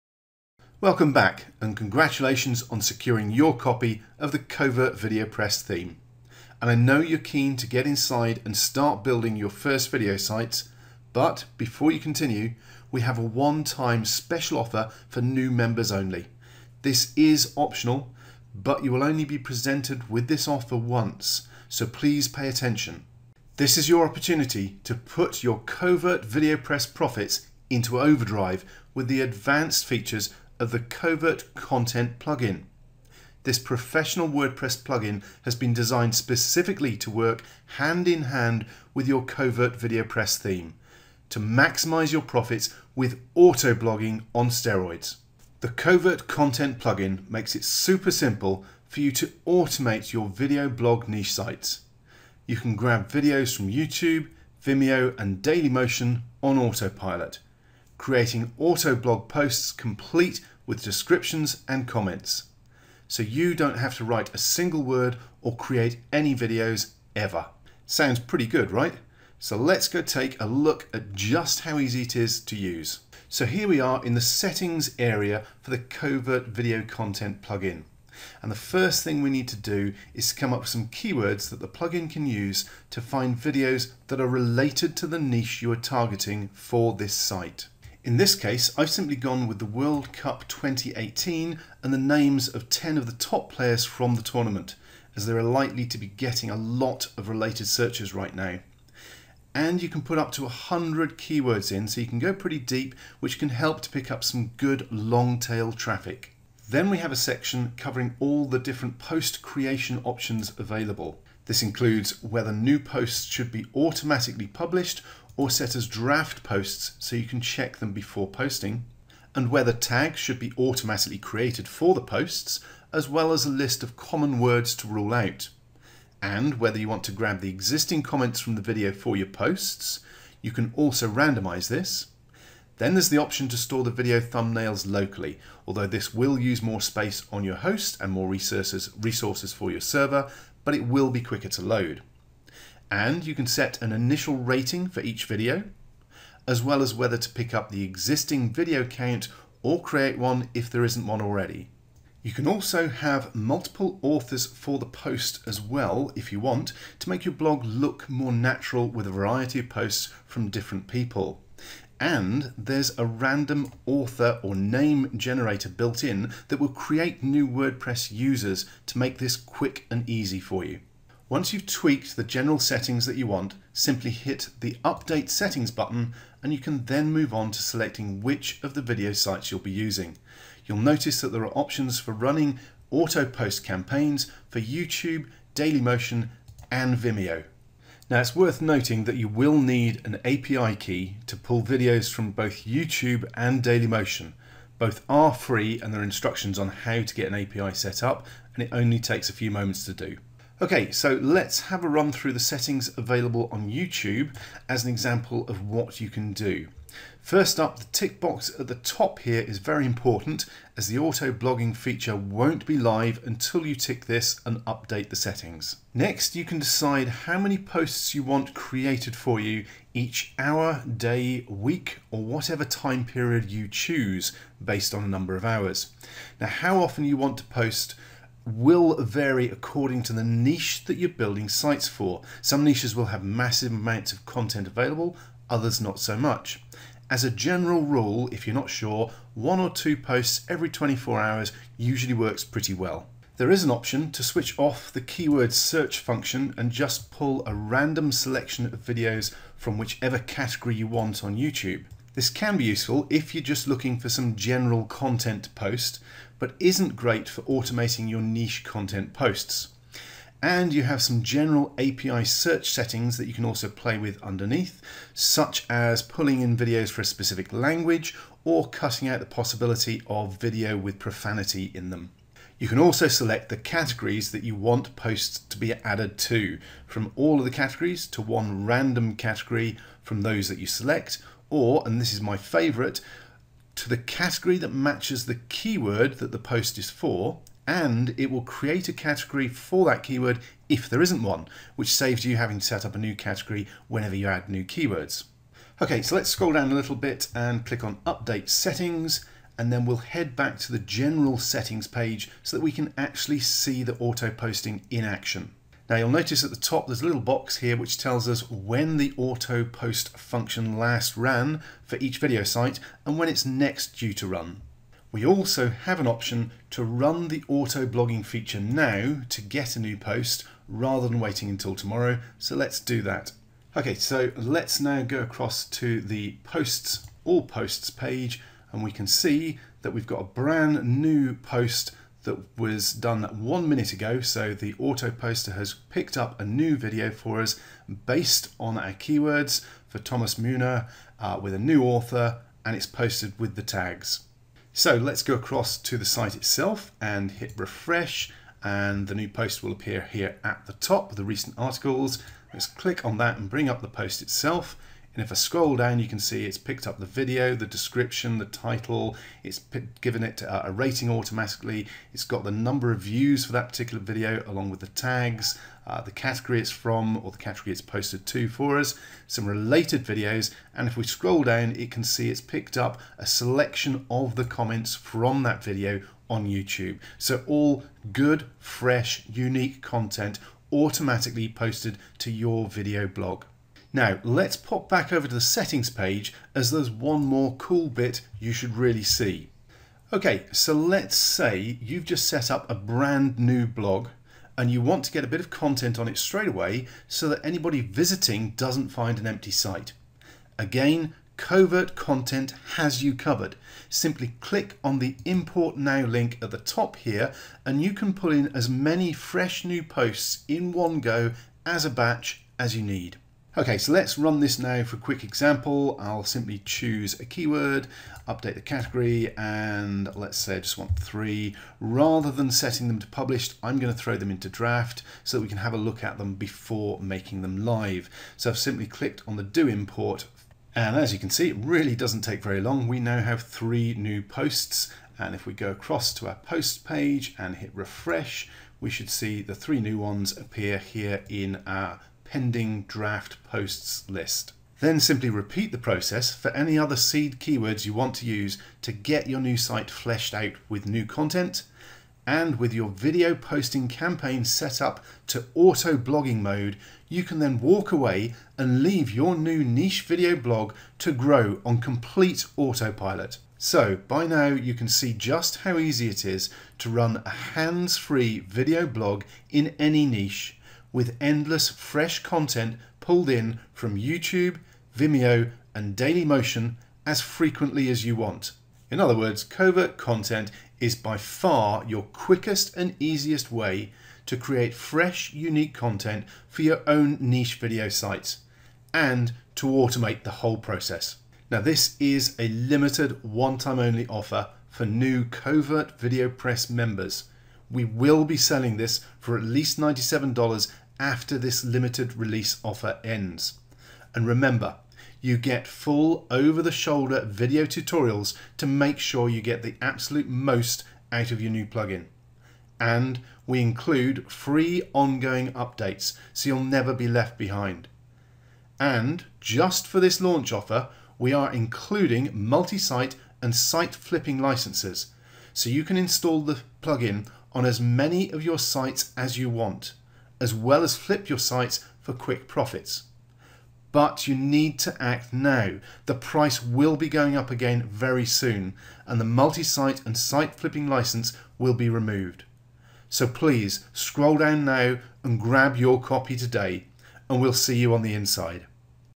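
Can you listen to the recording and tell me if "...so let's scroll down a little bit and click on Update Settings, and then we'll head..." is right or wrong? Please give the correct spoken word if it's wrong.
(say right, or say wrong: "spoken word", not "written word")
right.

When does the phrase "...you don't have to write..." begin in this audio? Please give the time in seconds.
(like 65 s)
63 s.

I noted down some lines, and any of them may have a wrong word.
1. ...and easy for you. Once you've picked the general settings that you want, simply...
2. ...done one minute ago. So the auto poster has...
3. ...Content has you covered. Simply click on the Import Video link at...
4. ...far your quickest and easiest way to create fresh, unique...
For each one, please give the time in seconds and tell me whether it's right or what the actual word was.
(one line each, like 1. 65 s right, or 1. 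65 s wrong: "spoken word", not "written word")
1. 169 s wrong: "tweaked", not "picked"
2. 332 s right
3. 401 s wrong: "Now", not "Video"
4. 481 s right.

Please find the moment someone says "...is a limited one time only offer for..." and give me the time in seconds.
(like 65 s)
491 s.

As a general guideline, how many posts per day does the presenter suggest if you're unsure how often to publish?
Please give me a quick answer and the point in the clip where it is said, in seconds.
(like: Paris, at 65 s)
one or two, at 239 s.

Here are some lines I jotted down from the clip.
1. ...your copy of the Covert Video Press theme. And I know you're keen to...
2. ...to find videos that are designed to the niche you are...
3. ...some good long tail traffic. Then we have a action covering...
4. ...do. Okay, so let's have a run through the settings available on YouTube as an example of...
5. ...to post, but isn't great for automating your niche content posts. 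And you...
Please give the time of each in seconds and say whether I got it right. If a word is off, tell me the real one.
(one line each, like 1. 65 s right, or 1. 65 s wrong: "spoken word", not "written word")
1. 3 s right
2. 82 s wrong: "related", not "designed"
3. 104 s wrong: "section", not "action"
4. 199 s right
5. 255 s right.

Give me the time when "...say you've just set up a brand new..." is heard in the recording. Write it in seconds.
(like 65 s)
391 s.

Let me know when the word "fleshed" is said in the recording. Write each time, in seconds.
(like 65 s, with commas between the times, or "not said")
449 s.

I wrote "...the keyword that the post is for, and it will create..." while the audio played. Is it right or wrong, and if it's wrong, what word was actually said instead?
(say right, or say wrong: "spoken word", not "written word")
right.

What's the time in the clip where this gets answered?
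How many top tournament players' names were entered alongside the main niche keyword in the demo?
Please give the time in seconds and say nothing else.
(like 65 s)
92 s.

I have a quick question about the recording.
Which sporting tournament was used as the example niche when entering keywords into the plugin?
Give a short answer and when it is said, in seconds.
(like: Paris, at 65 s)
World Cup 2018, at 89 s.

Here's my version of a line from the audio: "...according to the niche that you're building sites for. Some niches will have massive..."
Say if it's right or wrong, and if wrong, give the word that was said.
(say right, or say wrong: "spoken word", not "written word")
right.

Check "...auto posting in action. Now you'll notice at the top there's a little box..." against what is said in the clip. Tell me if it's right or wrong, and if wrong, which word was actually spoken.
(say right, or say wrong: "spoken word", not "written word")
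right.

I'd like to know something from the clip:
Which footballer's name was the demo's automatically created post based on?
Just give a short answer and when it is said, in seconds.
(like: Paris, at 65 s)
Thomas Müller, at 339 s.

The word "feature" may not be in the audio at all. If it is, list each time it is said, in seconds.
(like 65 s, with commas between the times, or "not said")
29 s, 211 s, 318 s.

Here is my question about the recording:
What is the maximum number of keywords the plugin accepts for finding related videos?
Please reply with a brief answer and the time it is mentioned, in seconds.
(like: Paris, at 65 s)
100, at 100 s.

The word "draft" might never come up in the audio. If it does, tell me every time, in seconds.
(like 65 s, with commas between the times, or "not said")
115 s, 424 s, 442 s.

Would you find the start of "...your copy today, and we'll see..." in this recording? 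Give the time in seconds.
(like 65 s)
545 s.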